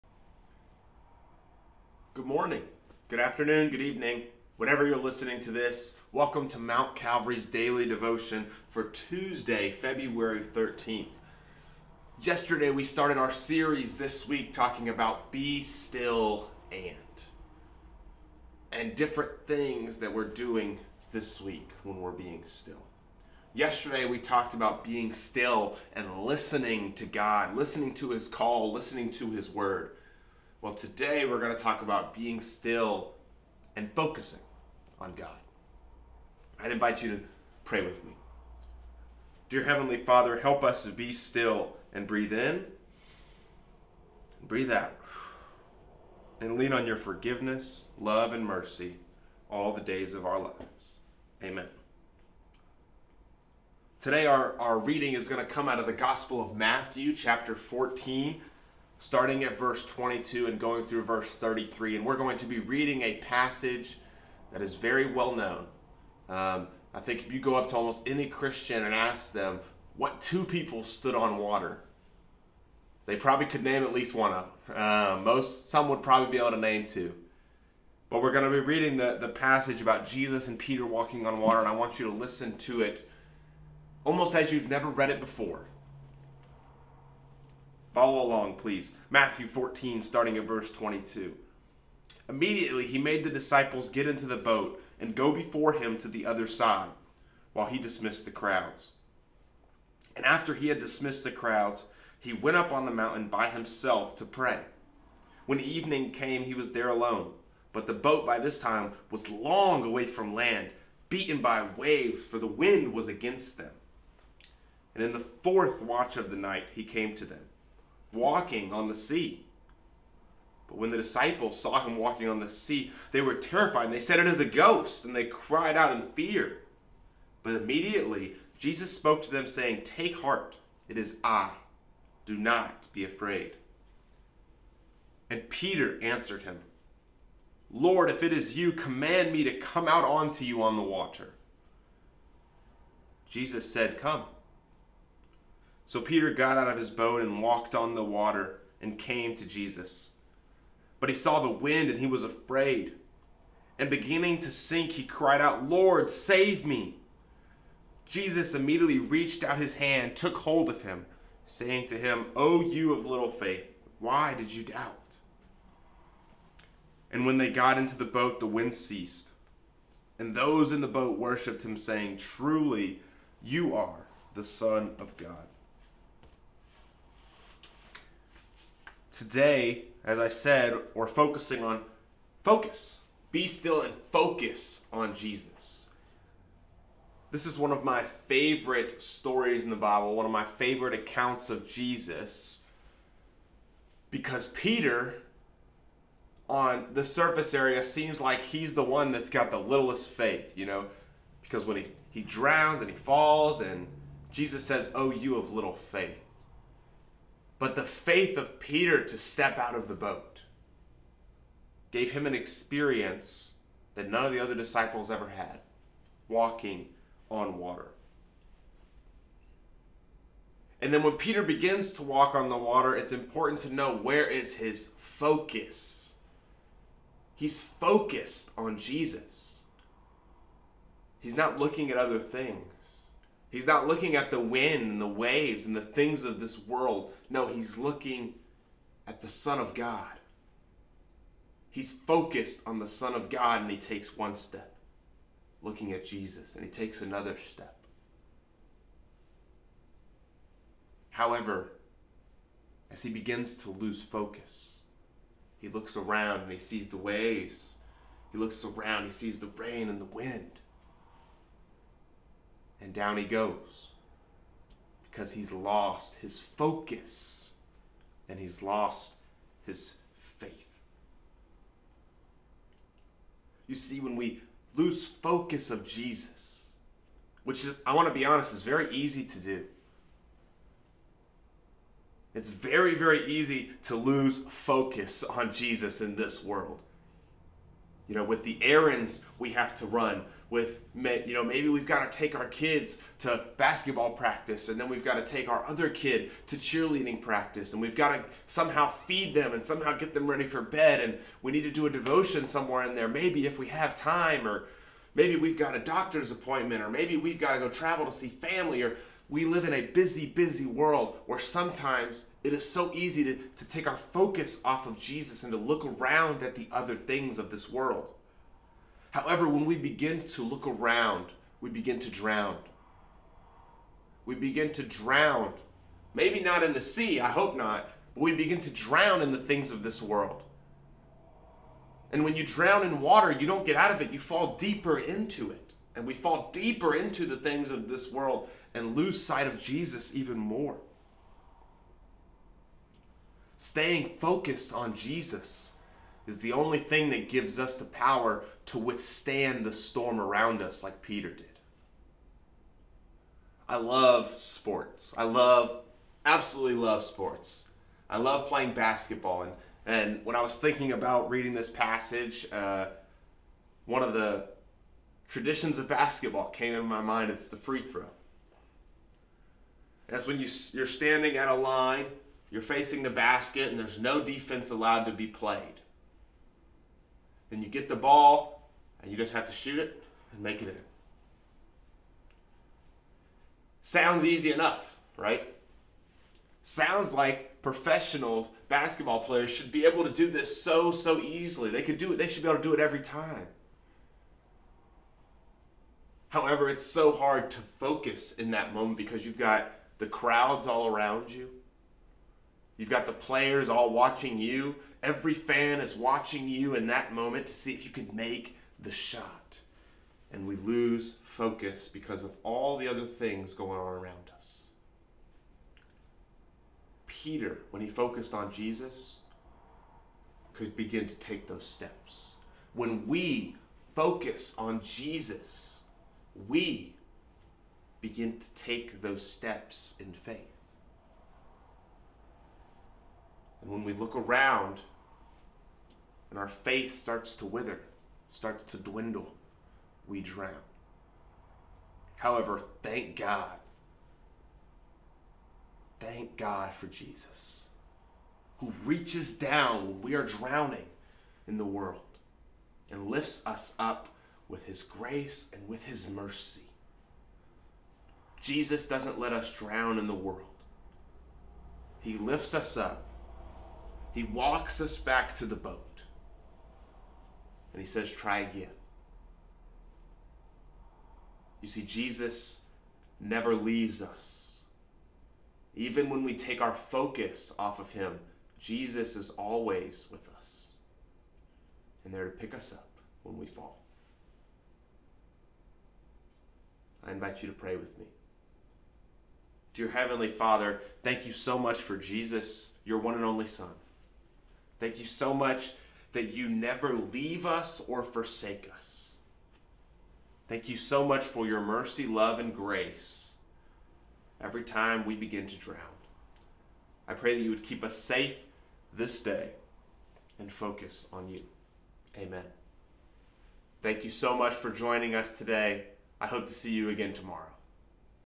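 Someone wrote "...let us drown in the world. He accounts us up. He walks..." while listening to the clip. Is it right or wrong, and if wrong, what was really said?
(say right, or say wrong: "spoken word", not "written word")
wrong: "lifts", not "accounts".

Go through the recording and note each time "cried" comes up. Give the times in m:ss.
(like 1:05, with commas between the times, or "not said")
2:05, 2:35.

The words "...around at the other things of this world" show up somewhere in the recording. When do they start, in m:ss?
5:15.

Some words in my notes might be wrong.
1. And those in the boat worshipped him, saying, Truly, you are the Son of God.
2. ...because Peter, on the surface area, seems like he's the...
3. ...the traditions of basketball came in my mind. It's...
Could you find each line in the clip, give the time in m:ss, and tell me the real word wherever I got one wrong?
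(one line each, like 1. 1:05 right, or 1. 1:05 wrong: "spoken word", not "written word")
1. 2:50 right
2. 3:14 right
3. 6:04 right.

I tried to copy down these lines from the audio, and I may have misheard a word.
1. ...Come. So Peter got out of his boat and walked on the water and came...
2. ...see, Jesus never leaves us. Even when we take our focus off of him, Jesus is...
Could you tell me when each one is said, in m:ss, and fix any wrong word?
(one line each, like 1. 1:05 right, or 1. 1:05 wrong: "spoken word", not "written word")
1. 2:23 right
2. 7:51 right.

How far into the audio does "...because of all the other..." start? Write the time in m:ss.
6:51.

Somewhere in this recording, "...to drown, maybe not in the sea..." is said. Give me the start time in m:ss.
5:24.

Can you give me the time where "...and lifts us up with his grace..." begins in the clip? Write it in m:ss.
7:32.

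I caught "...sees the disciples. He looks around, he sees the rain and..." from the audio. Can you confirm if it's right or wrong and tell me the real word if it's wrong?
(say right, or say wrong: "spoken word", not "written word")
wrong: "waves", not "disciples".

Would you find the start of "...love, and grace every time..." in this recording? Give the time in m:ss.
8:22.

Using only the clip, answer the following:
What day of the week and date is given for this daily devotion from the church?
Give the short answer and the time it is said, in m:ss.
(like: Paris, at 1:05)
Tuesday, February 13th, at 0:08.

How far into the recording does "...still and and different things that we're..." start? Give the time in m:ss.
0:15.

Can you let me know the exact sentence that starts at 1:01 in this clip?
And we're going to be reading a passage that is very well known.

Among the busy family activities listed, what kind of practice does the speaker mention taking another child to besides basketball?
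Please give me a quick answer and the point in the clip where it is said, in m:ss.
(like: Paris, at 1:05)
cheerleading, at 4:56.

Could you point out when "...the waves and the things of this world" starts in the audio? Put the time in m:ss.
3:55.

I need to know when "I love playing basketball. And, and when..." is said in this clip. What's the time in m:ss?
5:58.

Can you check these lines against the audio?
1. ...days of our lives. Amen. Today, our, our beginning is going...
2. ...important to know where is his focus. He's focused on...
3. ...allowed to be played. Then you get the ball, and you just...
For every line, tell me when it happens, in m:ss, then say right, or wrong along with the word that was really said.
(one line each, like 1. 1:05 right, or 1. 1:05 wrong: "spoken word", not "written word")
1. 0:49 wrong: "reading", not "beginning"
2. 3:43 right
3. 6:14 right.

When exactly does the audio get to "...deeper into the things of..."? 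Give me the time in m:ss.
5:36.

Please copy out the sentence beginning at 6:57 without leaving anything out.
Peter, when he focused on Jesus, could begin to take those steps.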